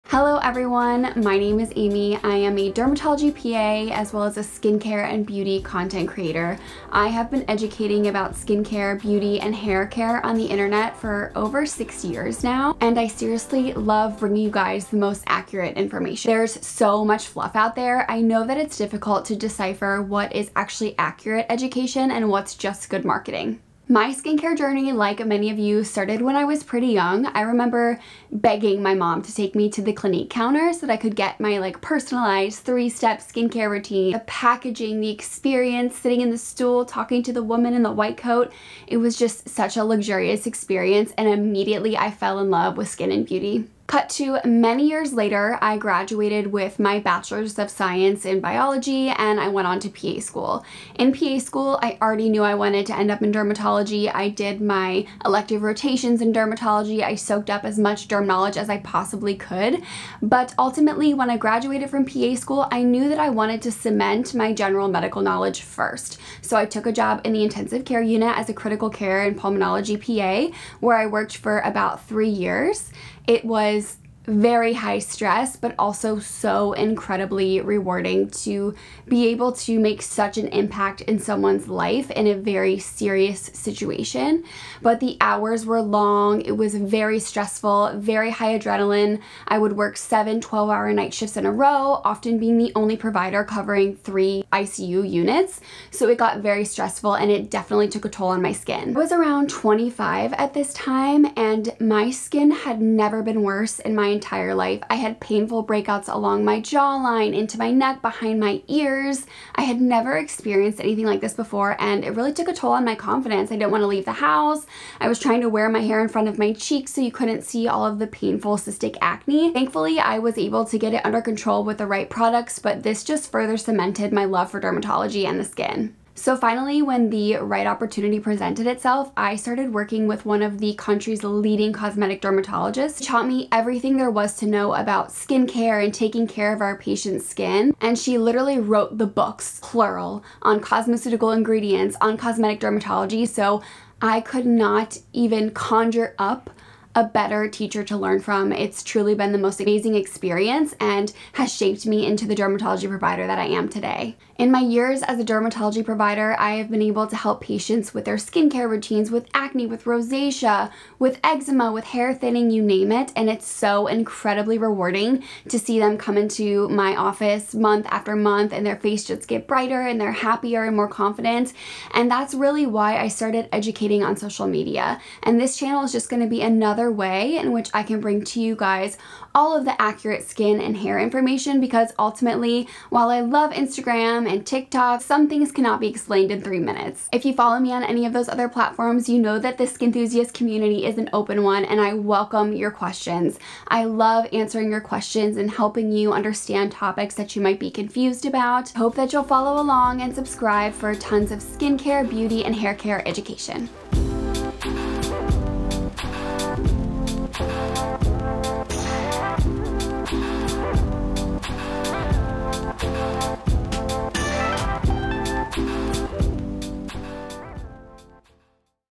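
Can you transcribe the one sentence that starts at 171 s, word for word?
And that's really why I started educating on social media.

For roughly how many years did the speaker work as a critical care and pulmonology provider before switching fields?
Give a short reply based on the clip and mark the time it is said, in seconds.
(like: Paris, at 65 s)
3, at 72 s.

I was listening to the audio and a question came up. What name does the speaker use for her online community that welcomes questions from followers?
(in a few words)
Skinthusiast.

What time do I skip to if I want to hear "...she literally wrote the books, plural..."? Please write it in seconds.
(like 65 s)
137 s.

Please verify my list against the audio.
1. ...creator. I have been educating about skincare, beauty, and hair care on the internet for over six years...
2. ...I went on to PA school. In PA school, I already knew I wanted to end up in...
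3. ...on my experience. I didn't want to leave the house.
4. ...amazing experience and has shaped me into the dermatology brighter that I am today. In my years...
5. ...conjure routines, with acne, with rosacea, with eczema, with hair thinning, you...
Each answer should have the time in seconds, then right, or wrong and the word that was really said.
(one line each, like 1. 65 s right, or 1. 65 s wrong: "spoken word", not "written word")
1. 6 s right
2. 49 s right
3. 112 s wrong: "confidence", not "experience"
4. 149 s wrong: "provider", not "brighter"
5. 158 s wrong: "skincare", not "conjure".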